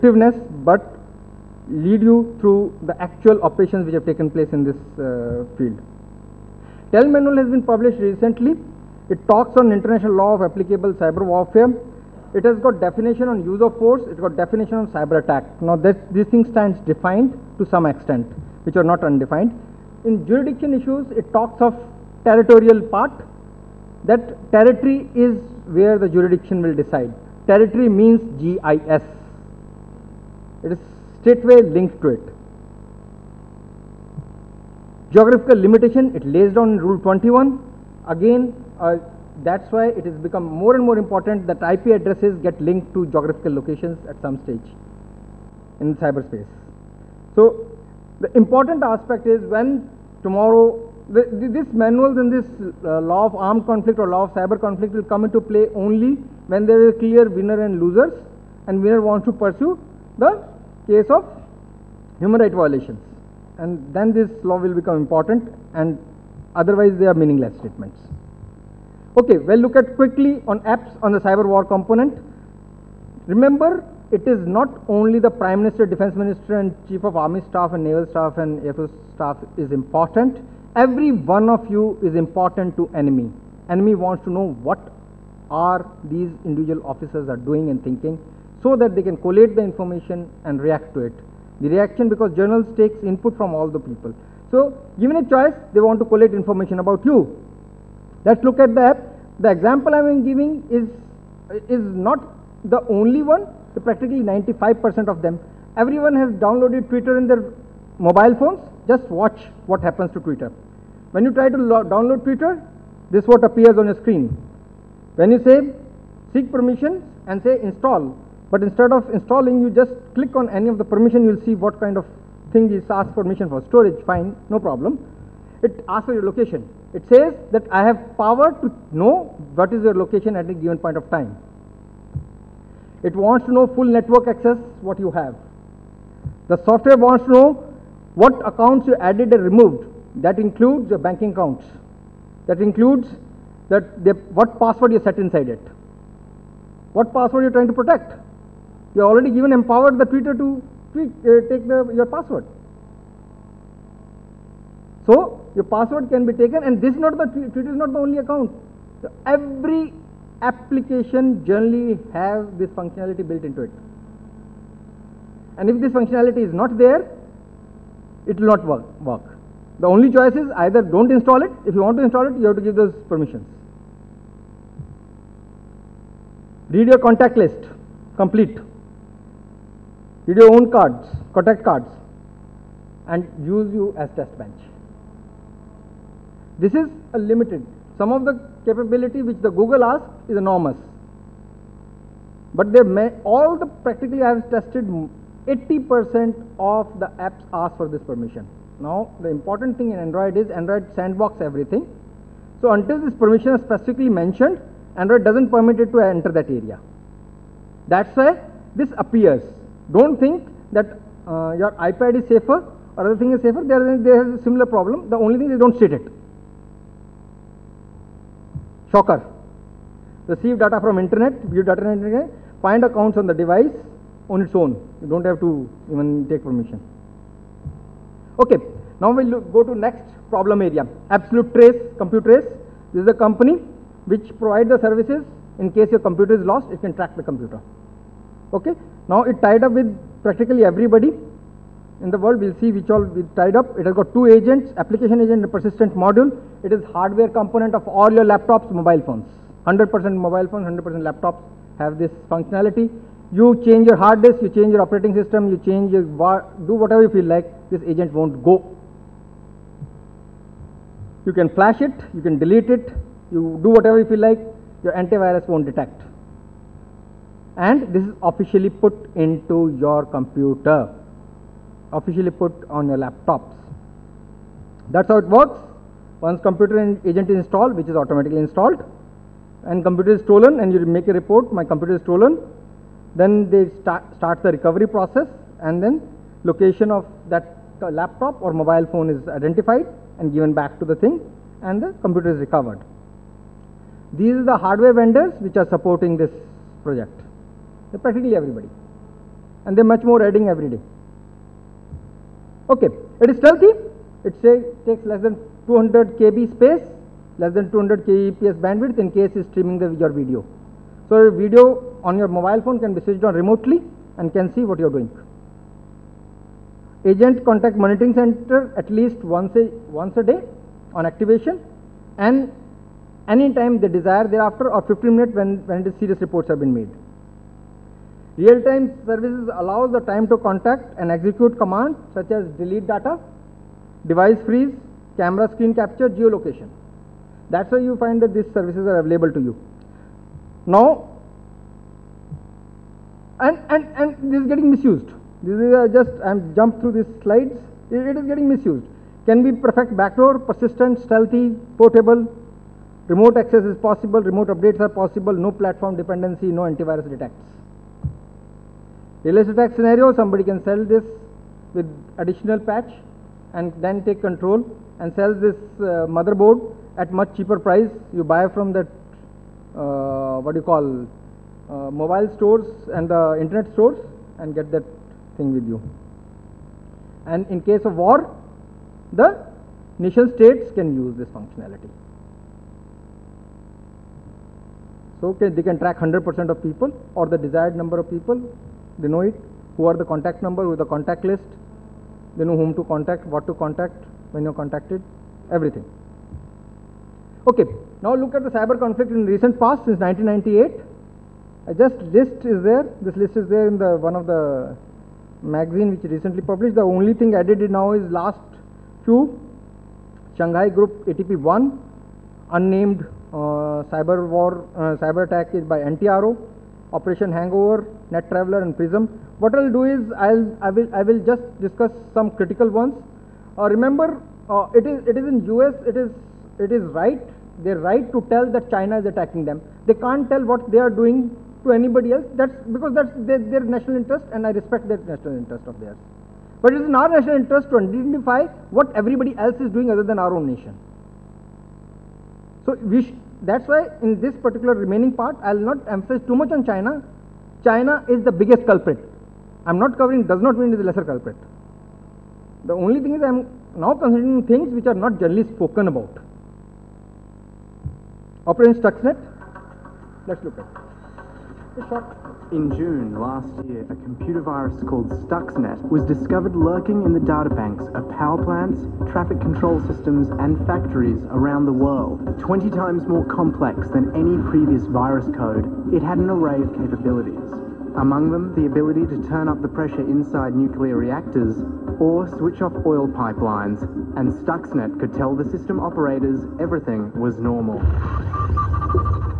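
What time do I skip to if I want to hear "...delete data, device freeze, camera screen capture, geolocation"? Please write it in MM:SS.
05:32.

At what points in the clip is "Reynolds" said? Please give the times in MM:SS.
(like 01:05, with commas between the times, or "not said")
not said.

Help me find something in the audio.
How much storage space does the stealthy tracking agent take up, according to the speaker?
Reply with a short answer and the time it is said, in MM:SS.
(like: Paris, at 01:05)
less than 200 KB, at 05:05.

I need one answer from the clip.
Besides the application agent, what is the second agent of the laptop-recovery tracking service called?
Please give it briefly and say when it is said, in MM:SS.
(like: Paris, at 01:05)
persistent module, at 04:05.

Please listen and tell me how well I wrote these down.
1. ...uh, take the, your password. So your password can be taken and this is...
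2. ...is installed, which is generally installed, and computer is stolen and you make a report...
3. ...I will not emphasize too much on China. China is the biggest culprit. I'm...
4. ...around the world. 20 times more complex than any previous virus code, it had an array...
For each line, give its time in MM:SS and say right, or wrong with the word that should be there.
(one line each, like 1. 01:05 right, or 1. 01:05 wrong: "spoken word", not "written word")
1. 02:30 right
2. 04:37 wrong: "automatically", not "generally"
3. 07:25 right
4. 07:51 right.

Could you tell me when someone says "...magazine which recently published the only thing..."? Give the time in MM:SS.
06:45.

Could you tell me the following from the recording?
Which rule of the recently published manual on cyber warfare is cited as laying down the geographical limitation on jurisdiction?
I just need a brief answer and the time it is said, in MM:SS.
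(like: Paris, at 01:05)
Rule 21, at 00:36.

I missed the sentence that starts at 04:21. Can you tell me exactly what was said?
You can flash it, you can delete it, you do whatever you feel like, your antivirus won't detect.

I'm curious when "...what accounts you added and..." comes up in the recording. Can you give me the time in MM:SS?
02:18.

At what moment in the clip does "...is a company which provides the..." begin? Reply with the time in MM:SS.
03:53.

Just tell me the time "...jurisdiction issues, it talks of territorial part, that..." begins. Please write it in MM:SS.
00:20.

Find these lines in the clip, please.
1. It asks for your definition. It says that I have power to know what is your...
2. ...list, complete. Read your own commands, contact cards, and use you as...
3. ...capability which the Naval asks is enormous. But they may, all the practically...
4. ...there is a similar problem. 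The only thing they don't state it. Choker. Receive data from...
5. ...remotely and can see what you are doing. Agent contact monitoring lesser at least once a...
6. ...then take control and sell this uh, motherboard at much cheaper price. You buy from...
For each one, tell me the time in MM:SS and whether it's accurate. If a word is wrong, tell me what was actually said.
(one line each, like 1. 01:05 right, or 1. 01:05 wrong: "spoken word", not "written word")
1. 02:05 wrong: "location", not "definition"
2. 02:57 wrong: "cards", not "commands"
3. 03:08 wrong: "Google", not "Naval"
4. 03:34 right
5. 05:13 wrong: "center", not "lesser"
6. 06:03 right.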